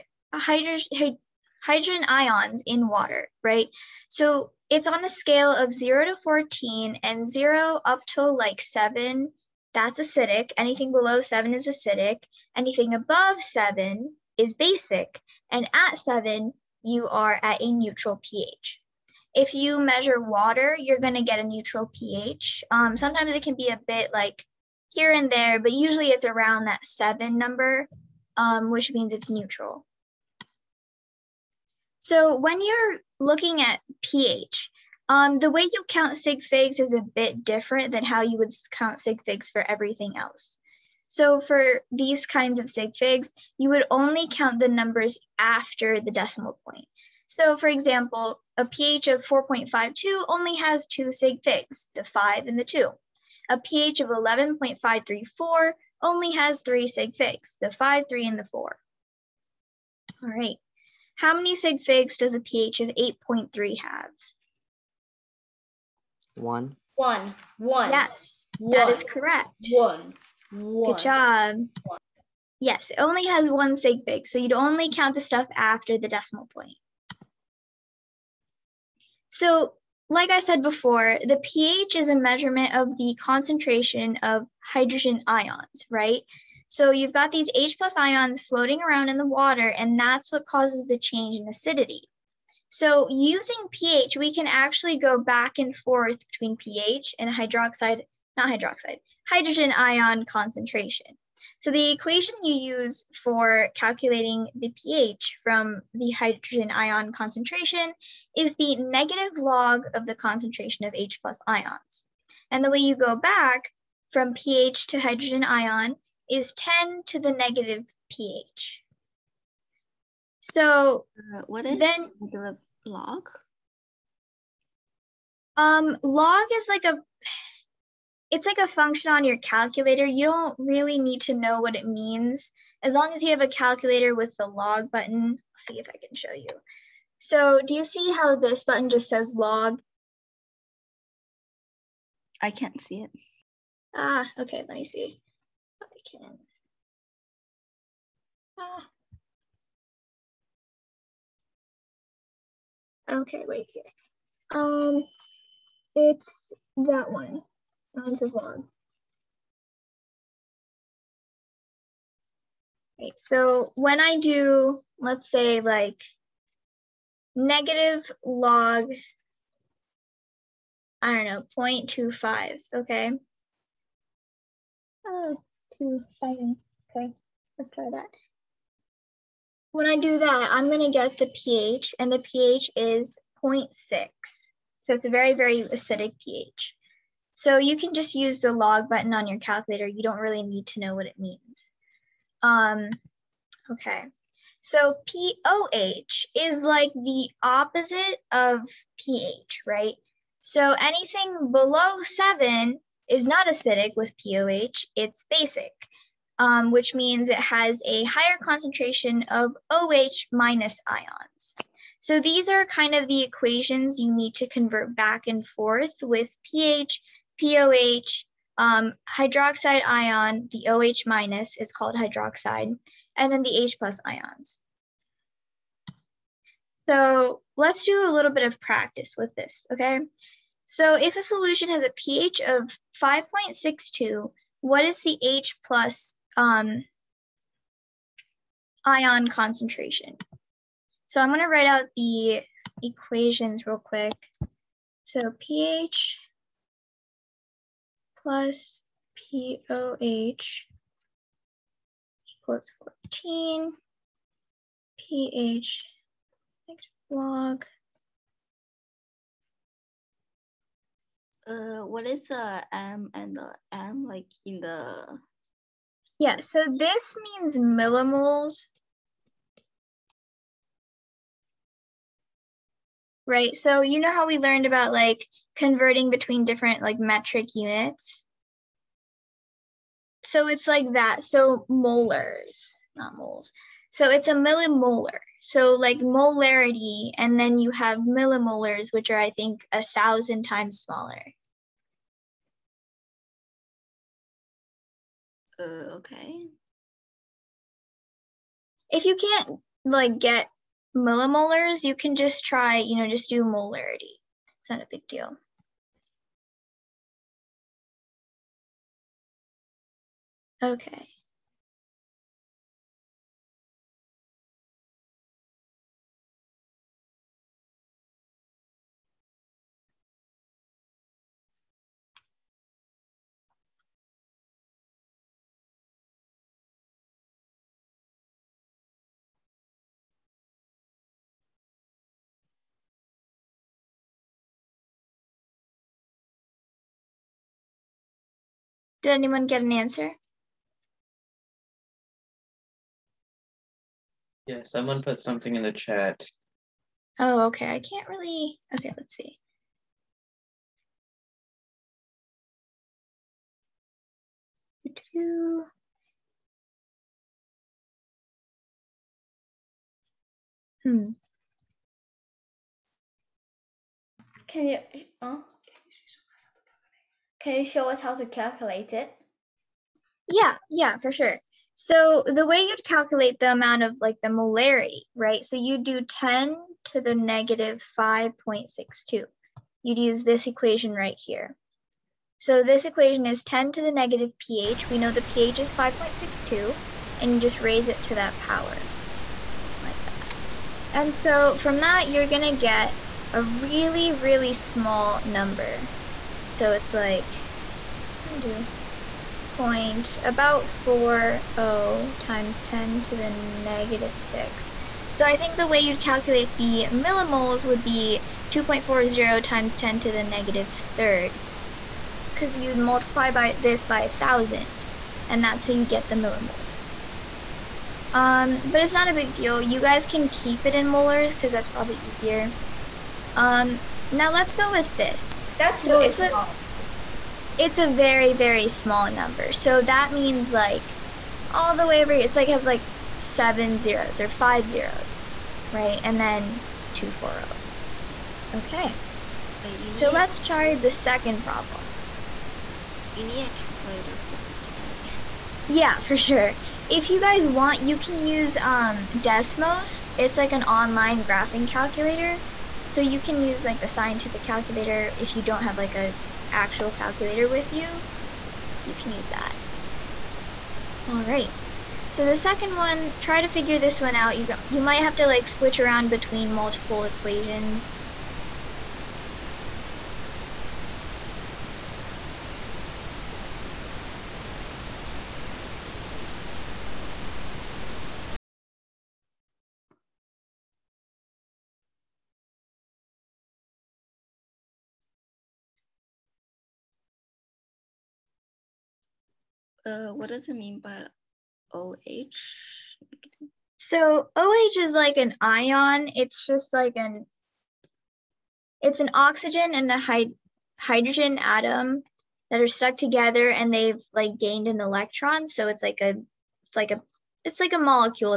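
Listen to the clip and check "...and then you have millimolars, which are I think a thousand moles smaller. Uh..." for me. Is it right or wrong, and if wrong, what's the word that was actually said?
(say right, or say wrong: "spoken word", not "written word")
wrong: "times", not "moles".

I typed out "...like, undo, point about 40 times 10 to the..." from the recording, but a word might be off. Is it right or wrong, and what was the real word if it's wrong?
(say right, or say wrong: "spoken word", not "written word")
right.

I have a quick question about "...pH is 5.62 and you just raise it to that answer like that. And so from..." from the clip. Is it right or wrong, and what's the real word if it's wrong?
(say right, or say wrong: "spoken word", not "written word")
wrong: "power", not "answer".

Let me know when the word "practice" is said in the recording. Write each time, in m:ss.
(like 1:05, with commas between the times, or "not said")
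3:48.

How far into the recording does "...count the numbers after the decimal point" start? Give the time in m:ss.
0:44.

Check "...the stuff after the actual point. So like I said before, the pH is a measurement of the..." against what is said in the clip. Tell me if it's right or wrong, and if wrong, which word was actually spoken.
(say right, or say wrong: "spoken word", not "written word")
wrong: "decimal", not "actual".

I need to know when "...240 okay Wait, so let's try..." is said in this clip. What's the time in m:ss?
7:16.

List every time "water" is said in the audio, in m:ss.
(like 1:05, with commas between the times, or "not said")
0:02, 0:20, 1:29.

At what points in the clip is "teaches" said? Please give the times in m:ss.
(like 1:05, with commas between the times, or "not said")
not said.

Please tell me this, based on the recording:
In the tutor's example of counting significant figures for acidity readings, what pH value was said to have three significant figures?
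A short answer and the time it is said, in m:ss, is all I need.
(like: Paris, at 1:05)
11.534, at 0:54.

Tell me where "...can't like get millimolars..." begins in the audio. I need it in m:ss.
4:59.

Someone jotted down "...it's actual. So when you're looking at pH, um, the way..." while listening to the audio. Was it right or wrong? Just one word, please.
wrong.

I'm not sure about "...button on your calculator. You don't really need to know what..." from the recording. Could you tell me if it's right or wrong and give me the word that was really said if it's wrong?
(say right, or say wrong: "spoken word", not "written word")
wrong: "function", not "button".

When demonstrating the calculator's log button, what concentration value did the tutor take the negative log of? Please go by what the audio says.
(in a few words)
0.25.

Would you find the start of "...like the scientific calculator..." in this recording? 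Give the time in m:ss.
7:33.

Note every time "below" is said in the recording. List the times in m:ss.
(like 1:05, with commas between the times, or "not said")
0:10, 3:21.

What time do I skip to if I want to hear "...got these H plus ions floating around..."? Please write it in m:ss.
1:27.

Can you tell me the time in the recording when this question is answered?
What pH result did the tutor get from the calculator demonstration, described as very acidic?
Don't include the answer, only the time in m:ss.
3:03.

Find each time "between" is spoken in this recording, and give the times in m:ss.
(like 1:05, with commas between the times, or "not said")
1:36, 4:36, 7:46.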